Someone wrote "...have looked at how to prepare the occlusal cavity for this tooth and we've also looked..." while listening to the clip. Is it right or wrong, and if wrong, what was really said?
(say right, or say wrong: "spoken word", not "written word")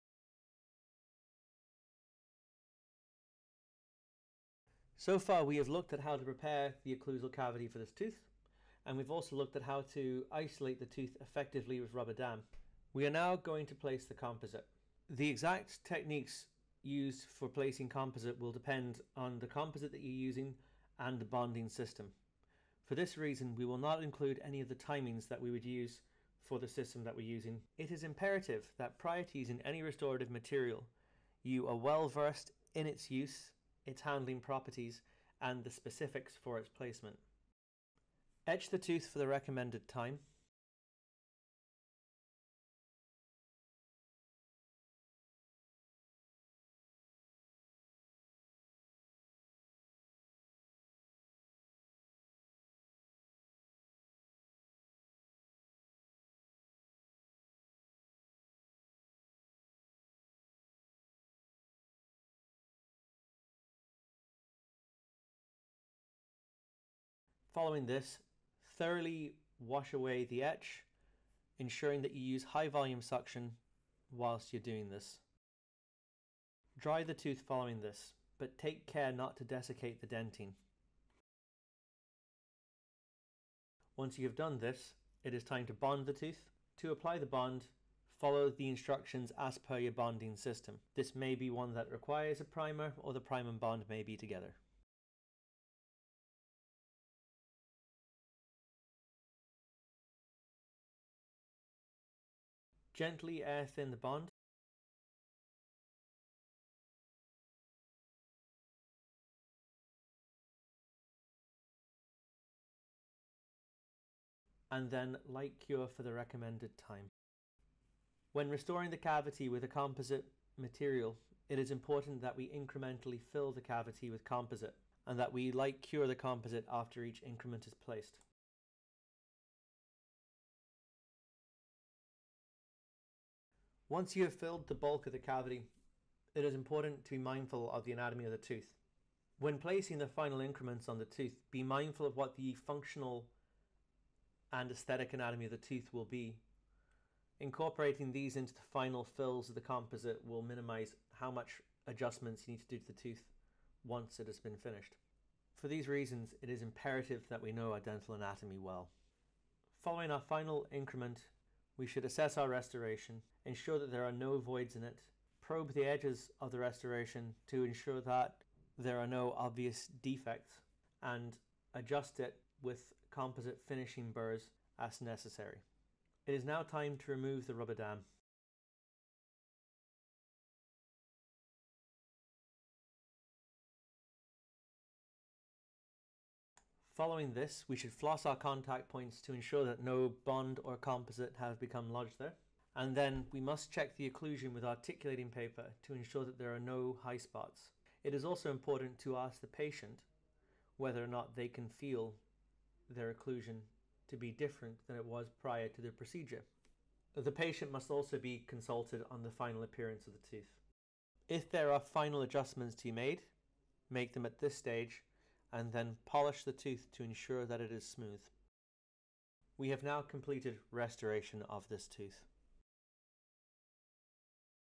right.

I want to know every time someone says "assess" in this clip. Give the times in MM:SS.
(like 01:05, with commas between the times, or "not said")
02:42.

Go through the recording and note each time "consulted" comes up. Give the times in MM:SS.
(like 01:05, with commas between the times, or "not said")
03:28.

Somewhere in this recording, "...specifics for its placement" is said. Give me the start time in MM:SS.
00:35.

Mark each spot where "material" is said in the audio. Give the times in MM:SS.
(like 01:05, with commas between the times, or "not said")
00:30, 02:00.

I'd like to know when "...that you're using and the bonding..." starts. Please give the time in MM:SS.
00:19.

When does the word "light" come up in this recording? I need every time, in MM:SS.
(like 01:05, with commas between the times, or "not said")
01:55, 02:05.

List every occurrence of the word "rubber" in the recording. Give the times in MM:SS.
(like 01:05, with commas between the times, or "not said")
00:11, 02:57.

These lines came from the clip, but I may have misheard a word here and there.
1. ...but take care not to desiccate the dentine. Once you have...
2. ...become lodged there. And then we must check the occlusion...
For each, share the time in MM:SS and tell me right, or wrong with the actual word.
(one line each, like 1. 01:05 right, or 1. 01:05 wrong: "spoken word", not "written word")
1. 01:18 right
2. 03:11 right.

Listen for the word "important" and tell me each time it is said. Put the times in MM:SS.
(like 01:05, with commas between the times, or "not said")
02:01, 02:16, 03:18.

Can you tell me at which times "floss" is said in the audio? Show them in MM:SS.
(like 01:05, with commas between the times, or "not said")
03:07.